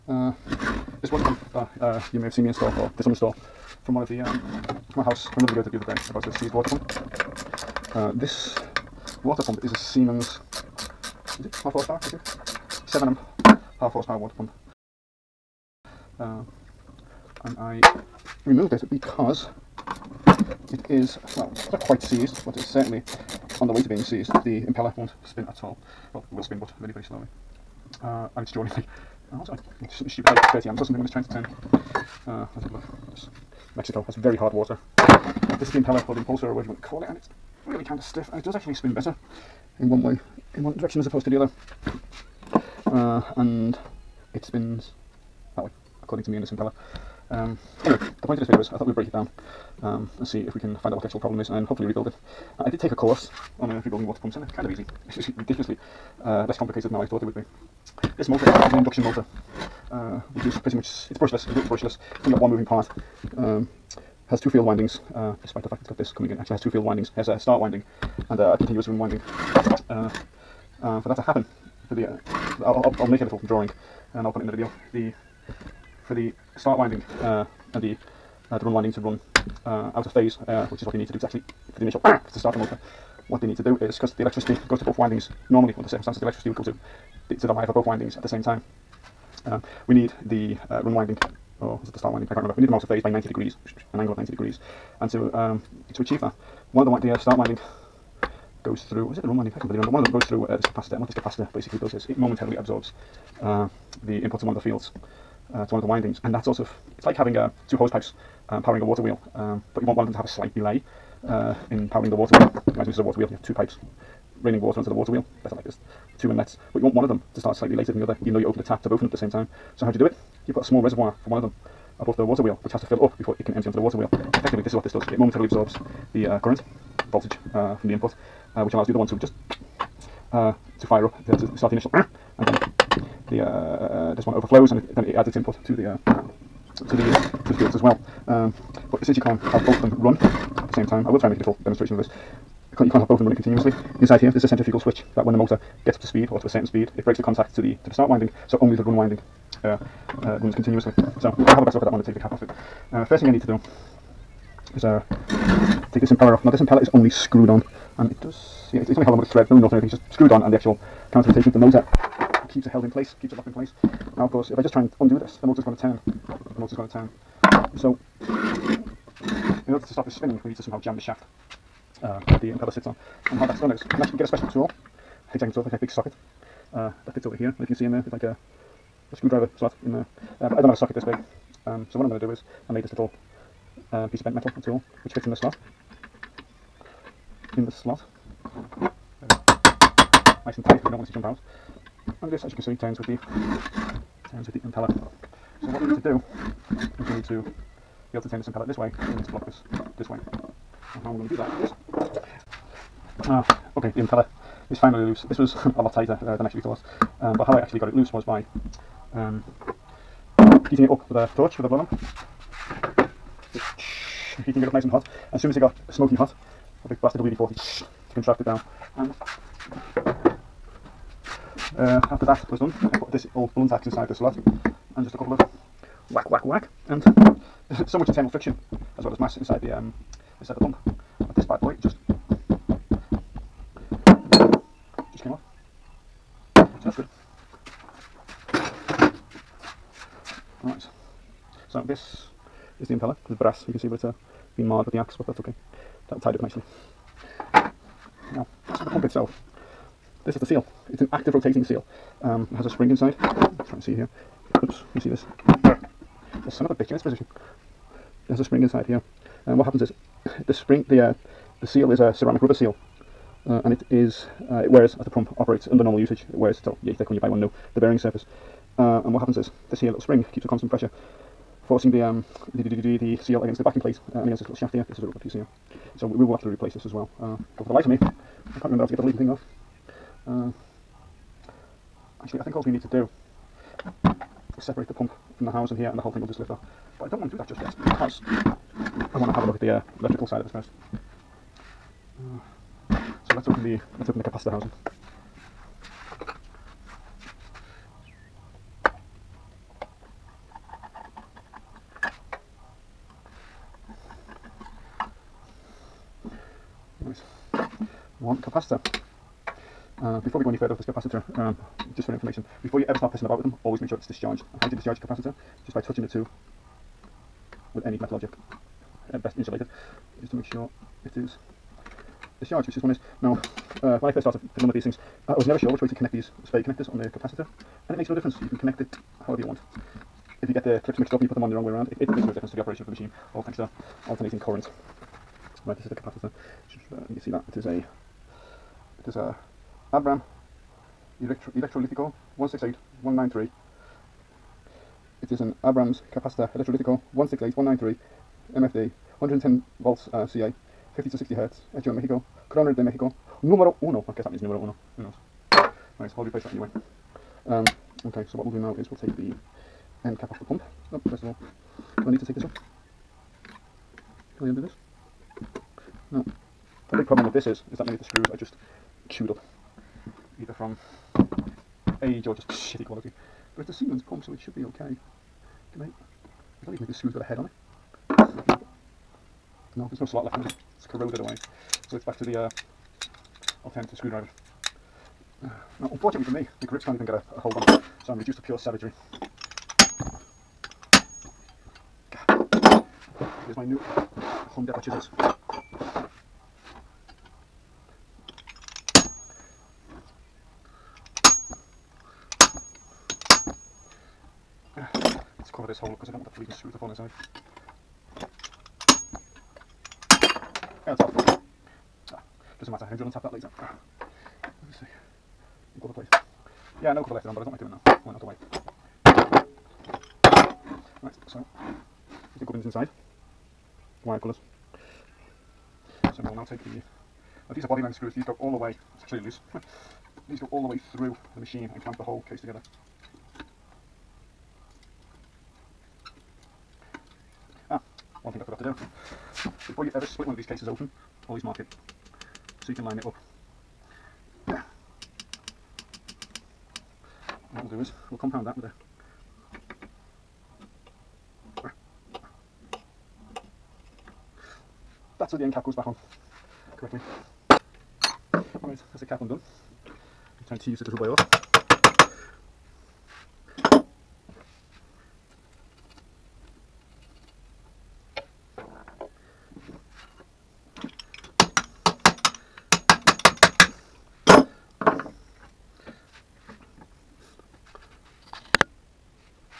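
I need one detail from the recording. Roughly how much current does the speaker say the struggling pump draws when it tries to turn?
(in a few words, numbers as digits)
30 amps.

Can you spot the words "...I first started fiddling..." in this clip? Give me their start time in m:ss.
5:24.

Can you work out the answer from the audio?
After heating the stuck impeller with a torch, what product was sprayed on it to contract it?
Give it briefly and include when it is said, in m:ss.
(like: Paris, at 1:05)
WD-40, at 3:37.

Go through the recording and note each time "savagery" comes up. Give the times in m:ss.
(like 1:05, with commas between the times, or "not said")
6:28.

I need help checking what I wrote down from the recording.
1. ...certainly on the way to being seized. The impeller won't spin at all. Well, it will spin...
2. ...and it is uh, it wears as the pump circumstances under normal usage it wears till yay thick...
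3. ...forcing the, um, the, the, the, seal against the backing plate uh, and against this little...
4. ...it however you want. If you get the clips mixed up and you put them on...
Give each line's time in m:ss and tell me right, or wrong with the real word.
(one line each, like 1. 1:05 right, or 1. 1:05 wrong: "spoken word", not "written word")
1. 0:22 right
2. 4:23 wrong: "operates", not "circumstances"
3. 4:31 right
4. 5:28 right.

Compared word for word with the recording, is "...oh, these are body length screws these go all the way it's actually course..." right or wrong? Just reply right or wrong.
wrong.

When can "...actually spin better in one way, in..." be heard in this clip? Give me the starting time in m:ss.
0:38.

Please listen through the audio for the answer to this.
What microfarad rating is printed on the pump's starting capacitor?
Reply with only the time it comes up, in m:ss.
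5:47.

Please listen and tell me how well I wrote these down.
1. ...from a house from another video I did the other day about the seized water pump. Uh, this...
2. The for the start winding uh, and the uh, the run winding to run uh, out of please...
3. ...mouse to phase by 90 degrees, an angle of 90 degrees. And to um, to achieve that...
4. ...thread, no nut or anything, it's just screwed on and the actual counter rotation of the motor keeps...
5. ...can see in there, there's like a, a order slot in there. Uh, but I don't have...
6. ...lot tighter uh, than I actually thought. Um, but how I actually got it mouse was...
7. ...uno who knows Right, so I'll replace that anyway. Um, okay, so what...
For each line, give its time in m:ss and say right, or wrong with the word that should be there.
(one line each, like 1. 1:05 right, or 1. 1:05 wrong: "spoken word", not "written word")
1. 0:04 right
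2. 1:14 wrong: "phase", not "please"
3. 1:32 right
4. 2:39 right
5. 2:57 wrong: "screwdriver", not "order"
6. 3:25 wrong: "loose", not "mouse"
7. 5:54 right.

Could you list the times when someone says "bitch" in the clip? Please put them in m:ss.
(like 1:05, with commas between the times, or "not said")
4:16.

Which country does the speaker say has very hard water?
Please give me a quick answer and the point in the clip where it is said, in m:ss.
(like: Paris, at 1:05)
Mexico, at 0:33.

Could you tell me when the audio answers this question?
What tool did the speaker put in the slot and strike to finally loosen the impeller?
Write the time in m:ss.
3:43.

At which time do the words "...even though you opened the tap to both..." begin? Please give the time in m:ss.
1:58.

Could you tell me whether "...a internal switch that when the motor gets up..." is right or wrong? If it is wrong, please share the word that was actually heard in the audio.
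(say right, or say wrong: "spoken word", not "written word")
wrong: "centrifugal", not "internal".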